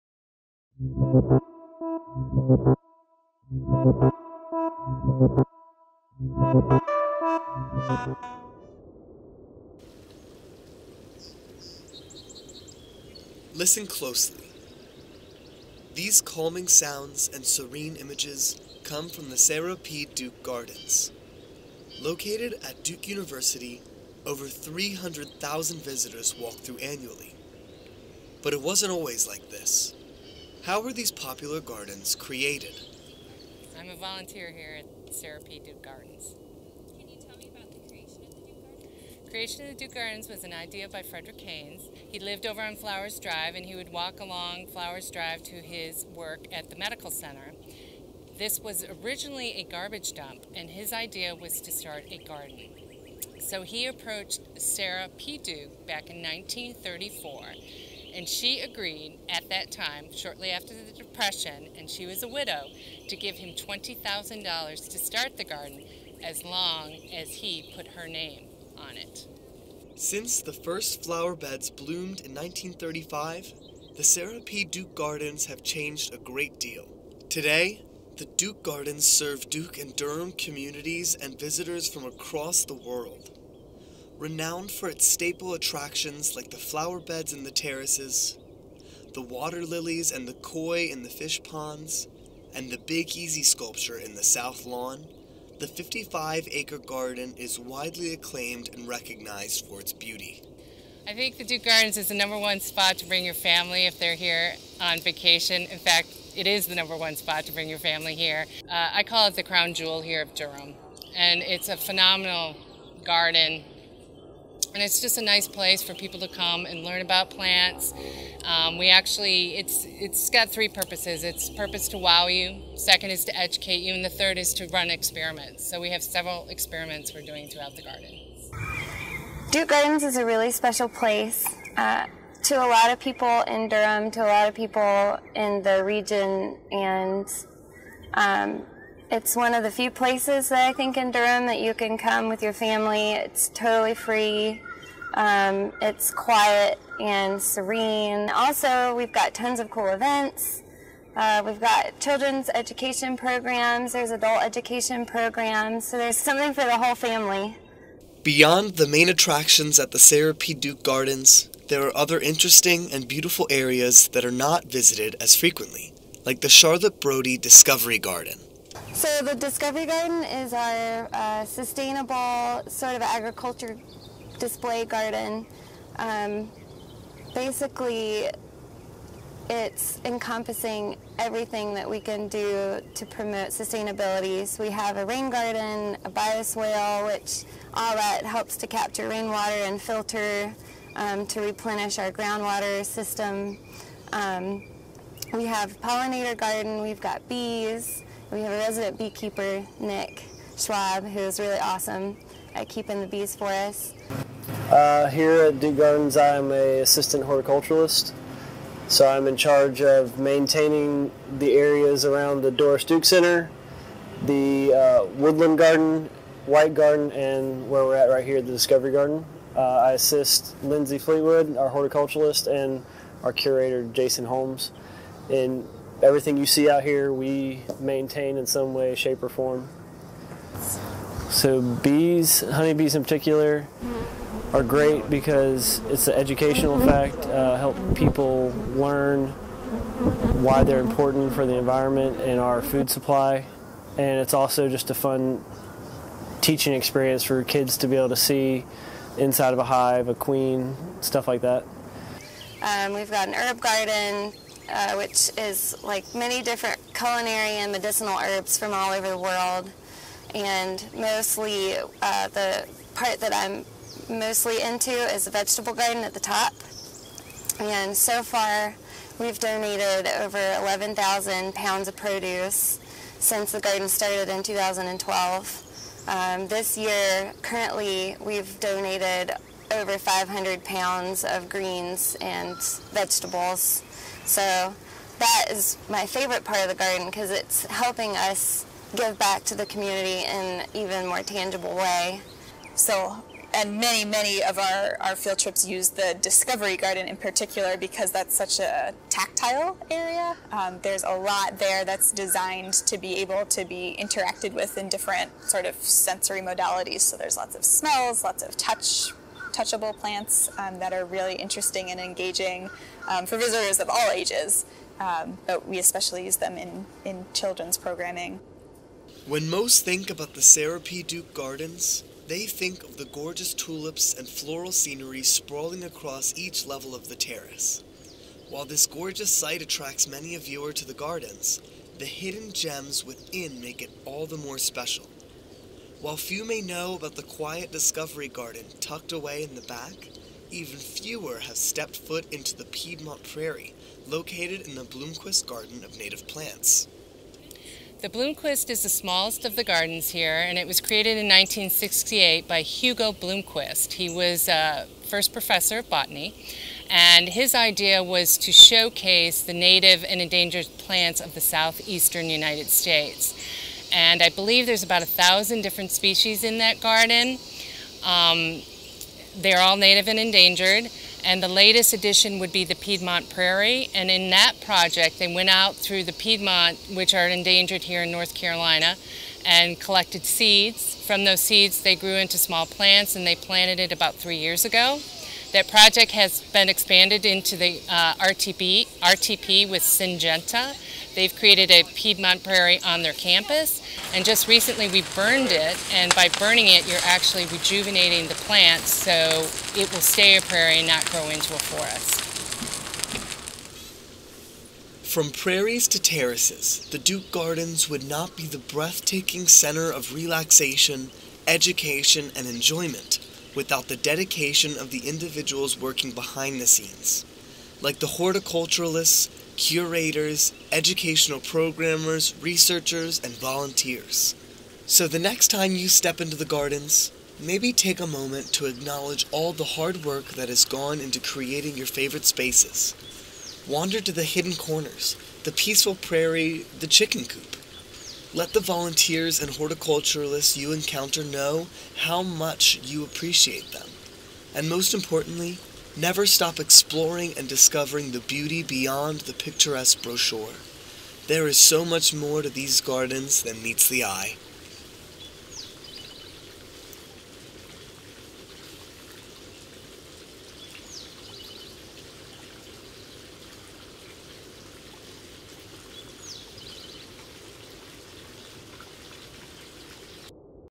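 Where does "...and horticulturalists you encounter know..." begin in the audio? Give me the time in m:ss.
7:19.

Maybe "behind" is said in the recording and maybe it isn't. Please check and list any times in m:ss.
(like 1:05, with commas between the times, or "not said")
6:56.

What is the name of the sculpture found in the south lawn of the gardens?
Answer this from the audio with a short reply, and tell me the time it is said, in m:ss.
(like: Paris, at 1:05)
Big Easy, at 1:32.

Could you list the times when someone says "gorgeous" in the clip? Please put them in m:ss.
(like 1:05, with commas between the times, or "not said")
5:23, 5:28.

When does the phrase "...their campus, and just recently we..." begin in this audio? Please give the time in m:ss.
6:33.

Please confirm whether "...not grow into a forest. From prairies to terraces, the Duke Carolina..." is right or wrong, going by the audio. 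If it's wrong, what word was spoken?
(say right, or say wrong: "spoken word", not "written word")
wrong: "Gardens", not "Carolina".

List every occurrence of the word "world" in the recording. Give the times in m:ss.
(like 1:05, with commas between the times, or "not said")
1:22, 4:19.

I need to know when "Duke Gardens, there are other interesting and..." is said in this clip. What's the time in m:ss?
2:40.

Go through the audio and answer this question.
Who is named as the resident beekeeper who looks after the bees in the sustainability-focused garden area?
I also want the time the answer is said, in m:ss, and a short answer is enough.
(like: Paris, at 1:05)
Nick Schwab, at 3:19.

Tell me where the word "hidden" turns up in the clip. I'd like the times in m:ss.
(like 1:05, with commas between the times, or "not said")
5:32, 7:14.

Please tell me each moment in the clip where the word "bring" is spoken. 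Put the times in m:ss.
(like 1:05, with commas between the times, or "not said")
1:43, 1:47.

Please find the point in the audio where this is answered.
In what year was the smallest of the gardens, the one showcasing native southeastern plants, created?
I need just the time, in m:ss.
5:51.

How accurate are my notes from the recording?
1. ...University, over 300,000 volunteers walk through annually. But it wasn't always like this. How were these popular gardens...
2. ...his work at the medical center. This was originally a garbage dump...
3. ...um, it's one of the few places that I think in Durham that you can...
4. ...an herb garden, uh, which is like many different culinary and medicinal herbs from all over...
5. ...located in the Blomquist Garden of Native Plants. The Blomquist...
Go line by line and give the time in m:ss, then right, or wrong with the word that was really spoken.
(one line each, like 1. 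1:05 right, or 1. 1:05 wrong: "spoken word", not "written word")
1. 0:23 wrong: "visitors", not "volunteers"
2. 0:45 right
3. 2:18 right
4. 4:13 right
5. 5:44 right.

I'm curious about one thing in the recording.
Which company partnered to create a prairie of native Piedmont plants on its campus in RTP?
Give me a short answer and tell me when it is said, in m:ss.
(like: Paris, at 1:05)
Syngenta, at 6:29.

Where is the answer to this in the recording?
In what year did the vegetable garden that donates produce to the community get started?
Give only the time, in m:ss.
4:34.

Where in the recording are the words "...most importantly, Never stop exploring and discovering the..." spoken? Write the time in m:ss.
7:24.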